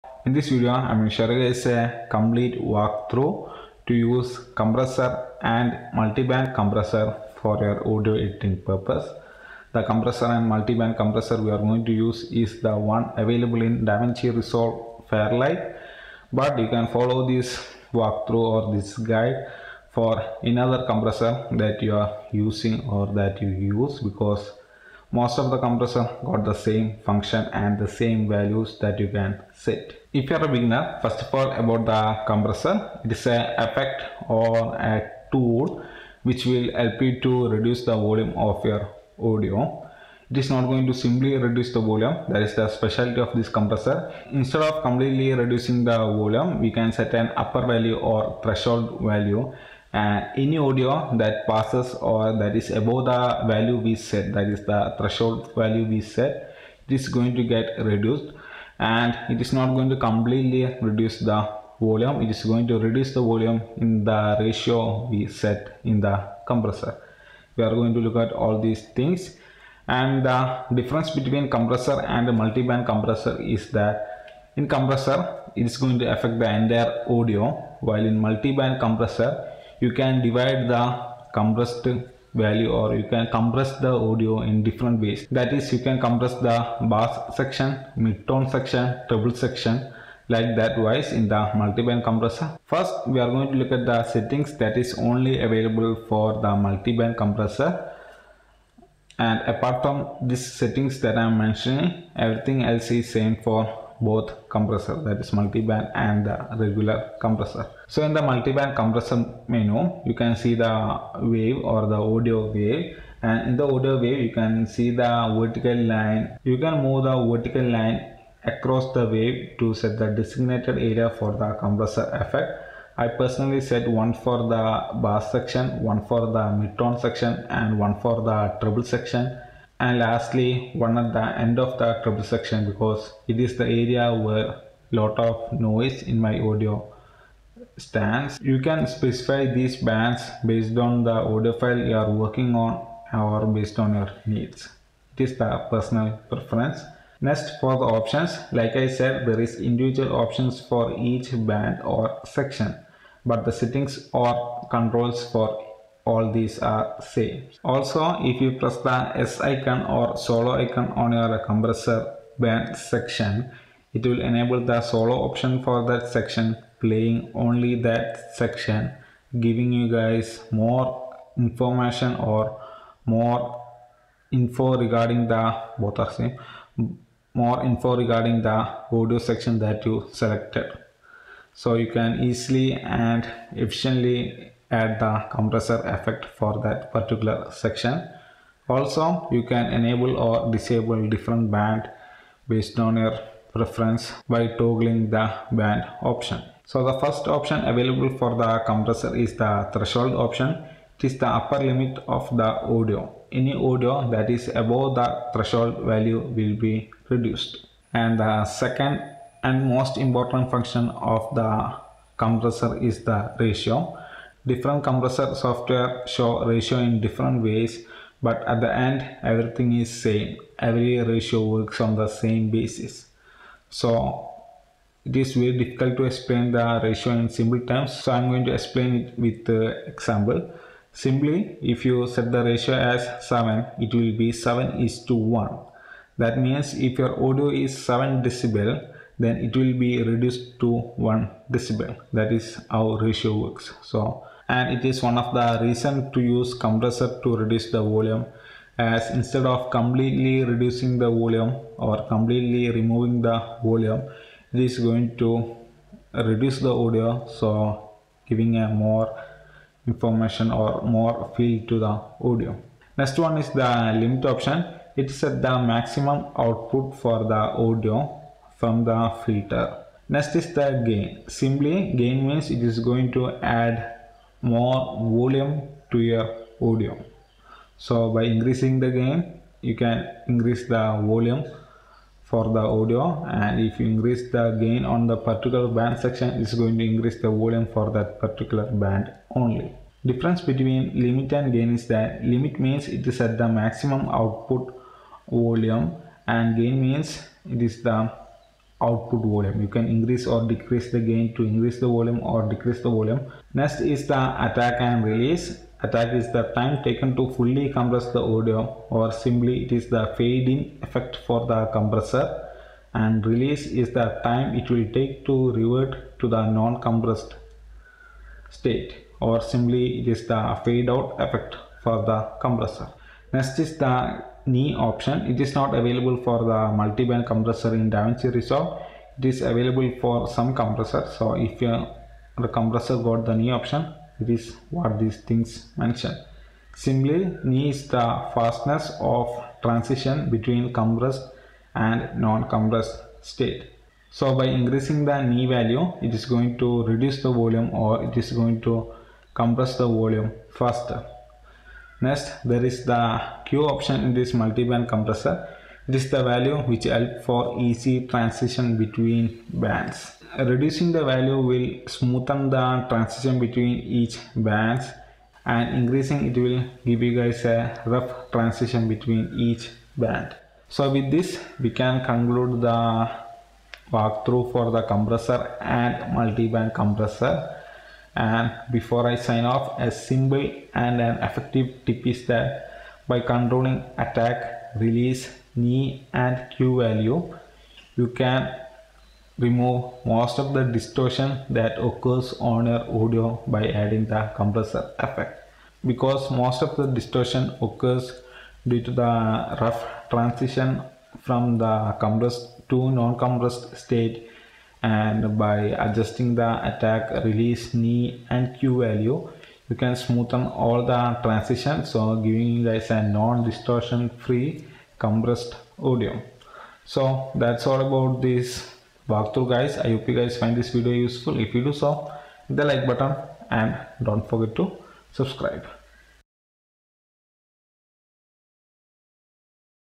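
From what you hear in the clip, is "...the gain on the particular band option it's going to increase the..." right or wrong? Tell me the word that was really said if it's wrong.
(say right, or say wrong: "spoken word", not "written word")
wrong: "section", not "option".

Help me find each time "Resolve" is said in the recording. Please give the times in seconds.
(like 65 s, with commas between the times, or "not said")
14 s, 328 s.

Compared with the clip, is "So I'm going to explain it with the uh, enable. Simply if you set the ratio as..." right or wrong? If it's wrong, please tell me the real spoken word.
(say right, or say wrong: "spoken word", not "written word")
wrong: "example", not "enable".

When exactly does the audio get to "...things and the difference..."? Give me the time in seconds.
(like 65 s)
68 s.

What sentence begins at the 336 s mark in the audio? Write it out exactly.
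Similarly, knee is the fastness of transition between compressed and non-compressed state.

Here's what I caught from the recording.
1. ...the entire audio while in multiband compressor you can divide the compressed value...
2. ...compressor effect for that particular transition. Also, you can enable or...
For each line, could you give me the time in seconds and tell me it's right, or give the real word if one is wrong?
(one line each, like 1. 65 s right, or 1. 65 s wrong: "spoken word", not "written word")
1. 76 s right
2. 185 s wrong: "section", not "transition".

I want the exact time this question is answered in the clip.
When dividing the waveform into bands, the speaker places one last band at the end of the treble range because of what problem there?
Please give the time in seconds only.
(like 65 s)
135 s.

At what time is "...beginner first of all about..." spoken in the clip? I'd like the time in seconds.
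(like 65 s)
30 s.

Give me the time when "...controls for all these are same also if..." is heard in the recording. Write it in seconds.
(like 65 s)
154 s.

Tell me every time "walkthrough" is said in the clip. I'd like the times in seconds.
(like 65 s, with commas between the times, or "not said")
2 s, 17 s, 373 s, 419 s.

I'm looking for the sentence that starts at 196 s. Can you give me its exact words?
So the first option available for the compressor is the threshold option.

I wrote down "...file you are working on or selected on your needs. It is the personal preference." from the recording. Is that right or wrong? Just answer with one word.
wrong.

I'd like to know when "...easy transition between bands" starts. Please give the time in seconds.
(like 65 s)
357 s.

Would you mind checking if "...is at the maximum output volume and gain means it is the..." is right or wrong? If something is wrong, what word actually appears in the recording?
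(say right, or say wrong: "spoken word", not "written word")
right.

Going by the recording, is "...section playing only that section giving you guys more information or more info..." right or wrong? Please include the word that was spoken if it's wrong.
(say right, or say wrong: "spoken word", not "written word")
right.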